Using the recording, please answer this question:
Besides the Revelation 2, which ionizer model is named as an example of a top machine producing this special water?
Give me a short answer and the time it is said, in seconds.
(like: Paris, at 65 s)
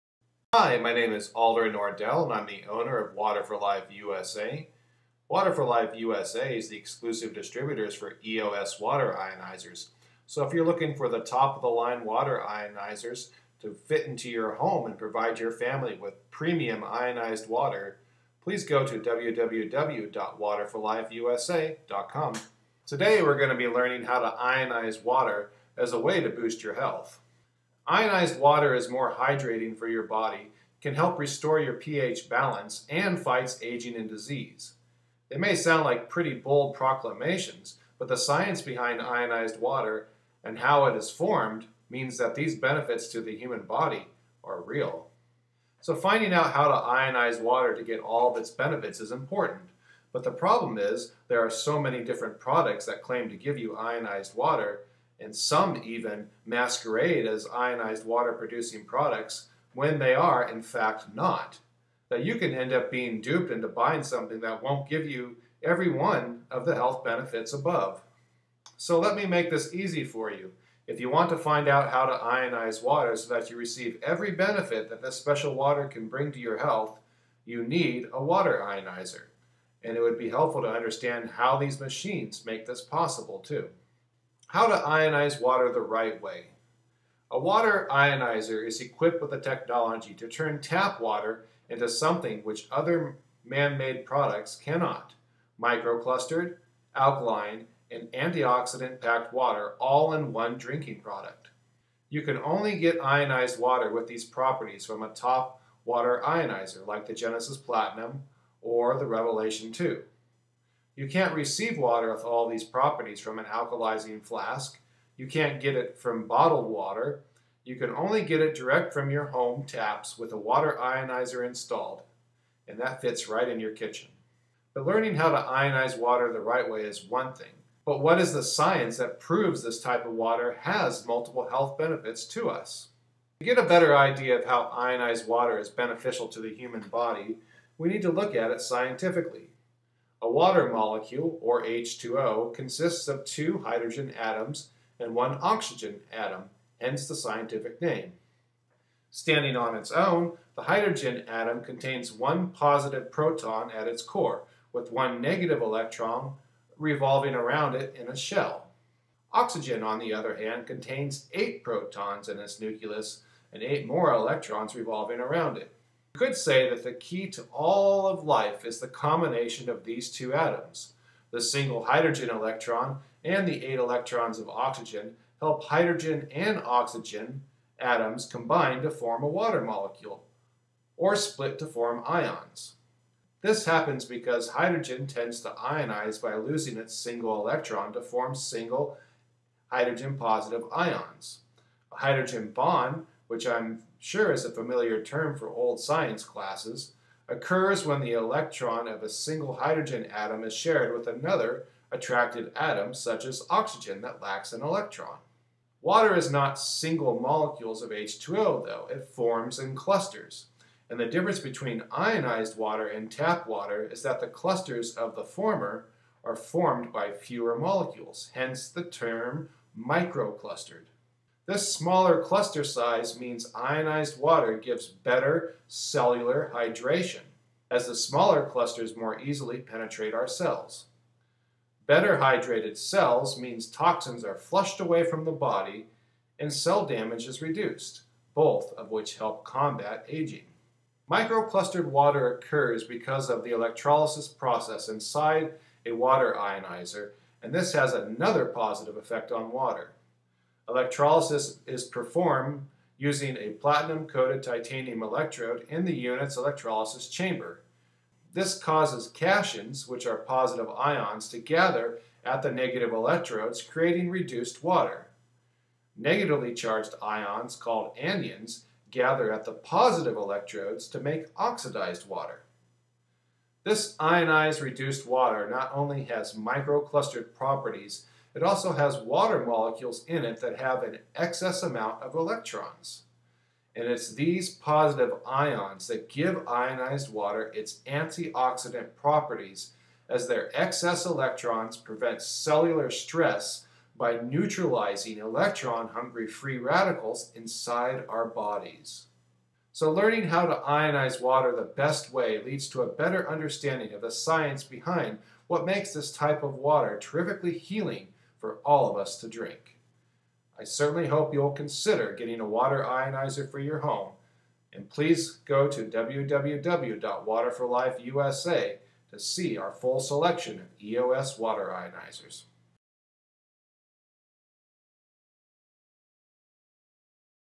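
Genesis Platinum, at 107 s.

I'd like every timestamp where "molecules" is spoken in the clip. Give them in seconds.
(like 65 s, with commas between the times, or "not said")
140 s, 179 s, 207 s, 217 s, 279 s.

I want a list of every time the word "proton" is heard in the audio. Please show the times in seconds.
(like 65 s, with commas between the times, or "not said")
153 s, 161 s.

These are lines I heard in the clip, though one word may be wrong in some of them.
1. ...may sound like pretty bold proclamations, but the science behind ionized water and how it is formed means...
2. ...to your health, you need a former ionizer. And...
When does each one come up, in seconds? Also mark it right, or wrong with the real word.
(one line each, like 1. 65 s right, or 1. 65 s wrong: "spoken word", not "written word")
1. 35 s right
2. 76 s wrong: "water", not "former".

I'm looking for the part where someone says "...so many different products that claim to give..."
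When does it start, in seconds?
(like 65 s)
51 s.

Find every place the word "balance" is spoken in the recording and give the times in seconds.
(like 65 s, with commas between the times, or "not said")
32 s.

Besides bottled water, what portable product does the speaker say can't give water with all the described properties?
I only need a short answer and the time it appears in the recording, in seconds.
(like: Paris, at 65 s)
alkalizing flask, at 113 s.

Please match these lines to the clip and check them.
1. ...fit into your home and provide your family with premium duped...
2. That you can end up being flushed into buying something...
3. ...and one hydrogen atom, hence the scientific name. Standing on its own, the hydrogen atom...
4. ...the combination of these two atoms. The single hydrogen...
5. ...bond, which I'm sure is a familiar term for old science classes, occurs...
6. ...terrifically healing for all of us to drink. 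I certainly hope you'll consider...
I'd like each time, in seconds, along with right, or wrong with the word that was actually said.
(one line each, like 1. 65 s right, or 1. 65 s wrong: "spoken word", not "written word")
1. 13 s wrong: "ionized", not "duped"
2. 62 s wrong: "duped", not "flushed"
3. 144 s wrong: "oxygen", not "hydrogen"
4. 168 s right
5. 192 s right
6. 306 s right.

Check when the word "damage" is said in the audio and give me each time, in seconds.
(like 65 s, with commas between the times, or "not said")
236 s.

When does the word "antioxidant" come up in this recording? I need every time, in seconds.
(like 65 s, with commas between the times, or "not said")
98 s, 287 s.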